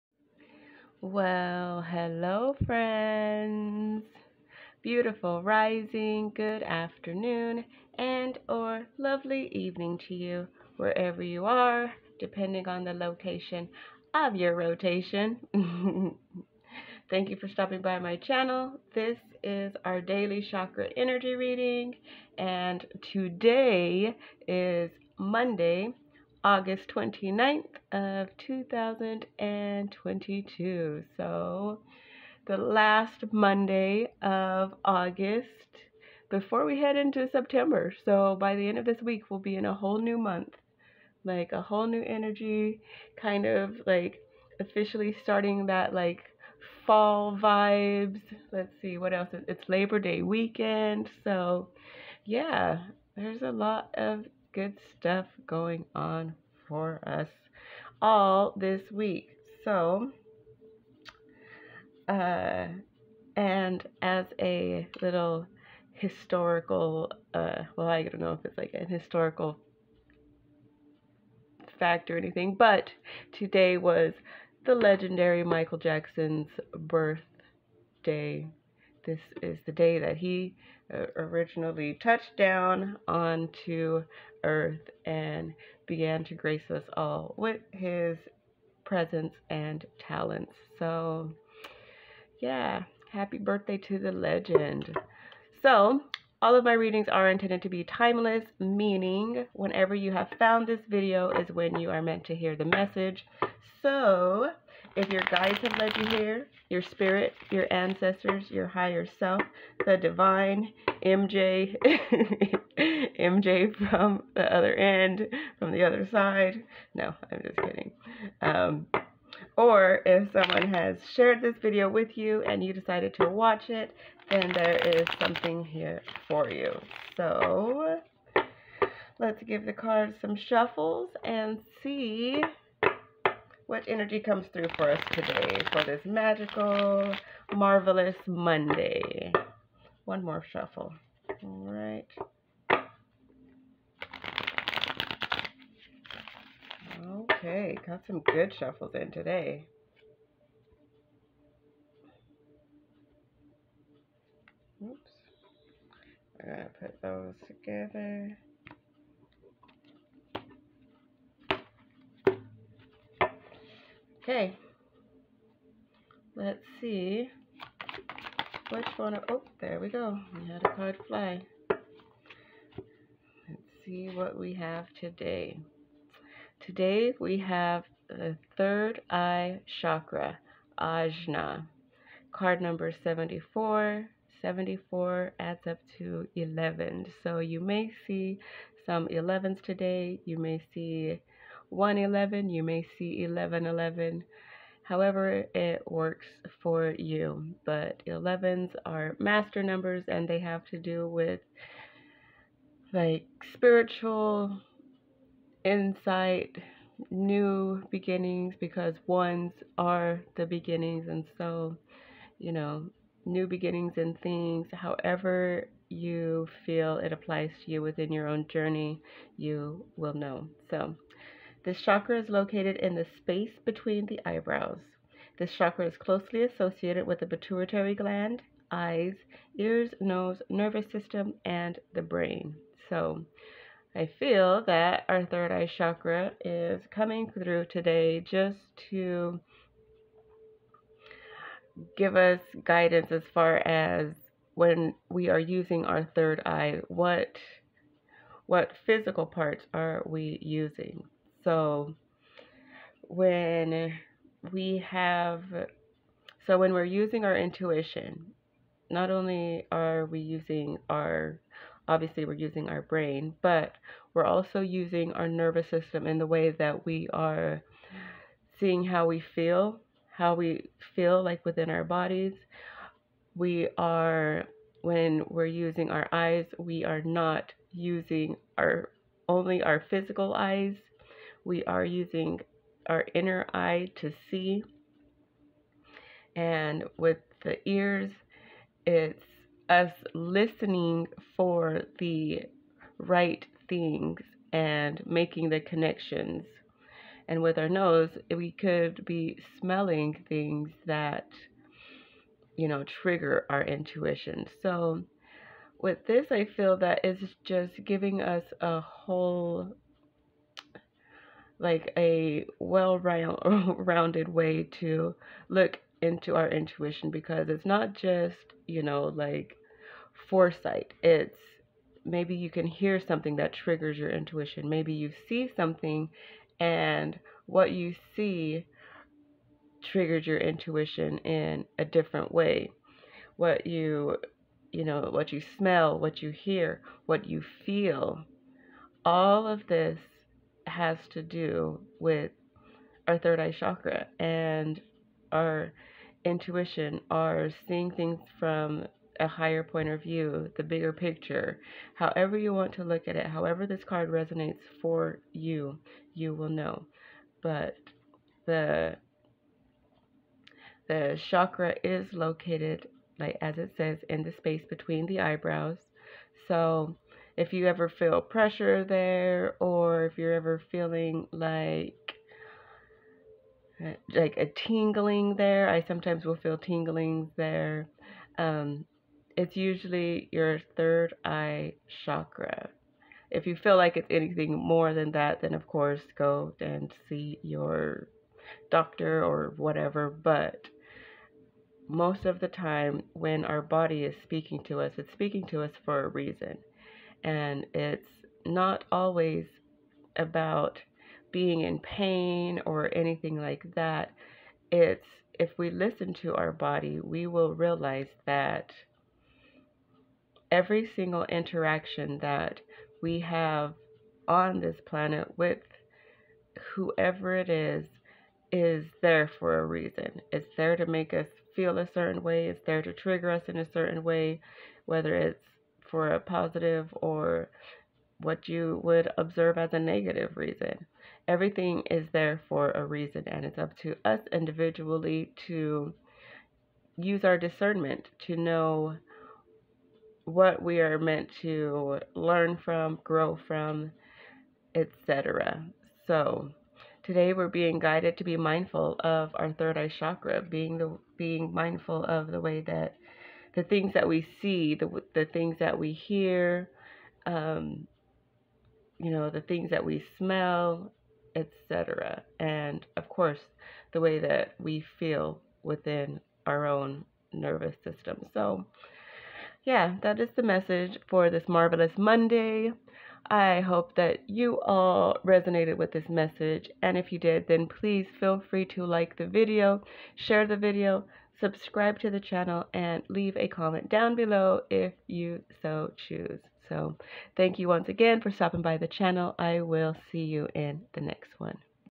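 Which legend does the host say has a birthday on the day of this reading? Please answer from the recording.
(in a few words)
Michael Jackson.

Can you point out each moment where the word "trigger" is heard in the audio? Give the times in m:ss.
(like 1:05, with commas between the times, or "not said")
5:03, 5:23, 5:29, 7:02.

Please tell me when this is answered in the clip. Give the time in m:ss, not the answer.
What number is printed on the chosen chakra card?
3:02.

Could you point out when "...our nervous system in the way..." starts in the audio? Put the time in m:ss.
4:25.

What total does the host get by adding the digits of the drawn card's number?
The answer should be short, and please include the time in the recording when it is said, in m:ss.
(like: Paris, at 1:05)
11, at 3:05.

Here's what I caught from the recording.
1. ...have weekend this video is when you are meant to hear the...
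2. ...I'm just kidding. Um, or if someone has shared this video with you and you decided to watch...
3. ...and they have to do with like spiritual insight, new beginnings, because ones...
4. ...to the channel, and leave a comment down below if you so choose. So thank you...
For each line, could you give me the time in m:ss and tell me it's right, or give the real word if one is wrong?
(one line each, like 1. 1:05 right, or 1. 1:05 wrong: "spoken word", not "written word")
1. 1:40 wrong: "found", not "weekend"
2. 1:57 right
3. 3:20 right
4. 8:01 right.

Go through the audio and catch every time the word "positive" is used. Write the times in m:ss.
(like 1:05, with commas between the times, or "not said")
7:06.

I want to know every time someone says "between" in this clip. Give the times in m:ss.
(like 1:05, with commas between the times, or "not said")
3:43, 6:04.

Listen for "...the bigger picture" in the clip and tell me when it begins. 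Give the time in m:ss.
5:50.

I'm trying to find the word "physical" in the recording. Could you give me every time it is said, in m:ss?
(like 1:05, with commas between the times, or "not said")
4:08, 4:39.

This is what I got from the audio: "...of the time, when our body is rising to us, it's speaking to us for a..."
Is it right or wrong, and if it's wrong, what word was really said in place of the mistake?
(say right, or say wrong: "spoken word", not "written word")
wrong: "speaking", not "rising".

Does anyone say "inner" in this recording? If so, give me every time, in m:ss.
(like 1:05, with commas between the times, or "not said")
4:43.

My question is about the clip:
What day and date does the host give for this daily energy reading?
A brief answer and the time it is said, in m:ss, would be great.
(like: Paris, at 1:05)
Monday, August 29th, at 0:25.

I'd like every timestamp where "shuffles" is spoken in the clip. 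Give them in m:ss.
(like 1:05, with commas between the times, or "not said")
2:10, 2:20, 2:28.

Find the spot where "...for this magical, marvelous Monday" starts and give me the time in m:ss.
2:15.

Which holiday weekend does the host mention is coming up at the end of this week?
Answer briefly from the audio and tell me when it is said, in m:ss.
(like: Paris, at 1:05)
Labor Day, at 0:49.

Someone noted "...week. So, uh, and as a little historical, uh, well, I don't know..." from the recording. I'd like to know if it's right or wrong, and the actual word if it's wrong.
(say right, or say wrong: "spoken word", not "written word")
right.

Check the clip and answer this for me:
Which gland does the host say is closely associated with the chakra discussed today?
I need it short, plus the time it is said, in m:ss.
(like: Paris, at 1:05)
pituitary gland, at 3:47.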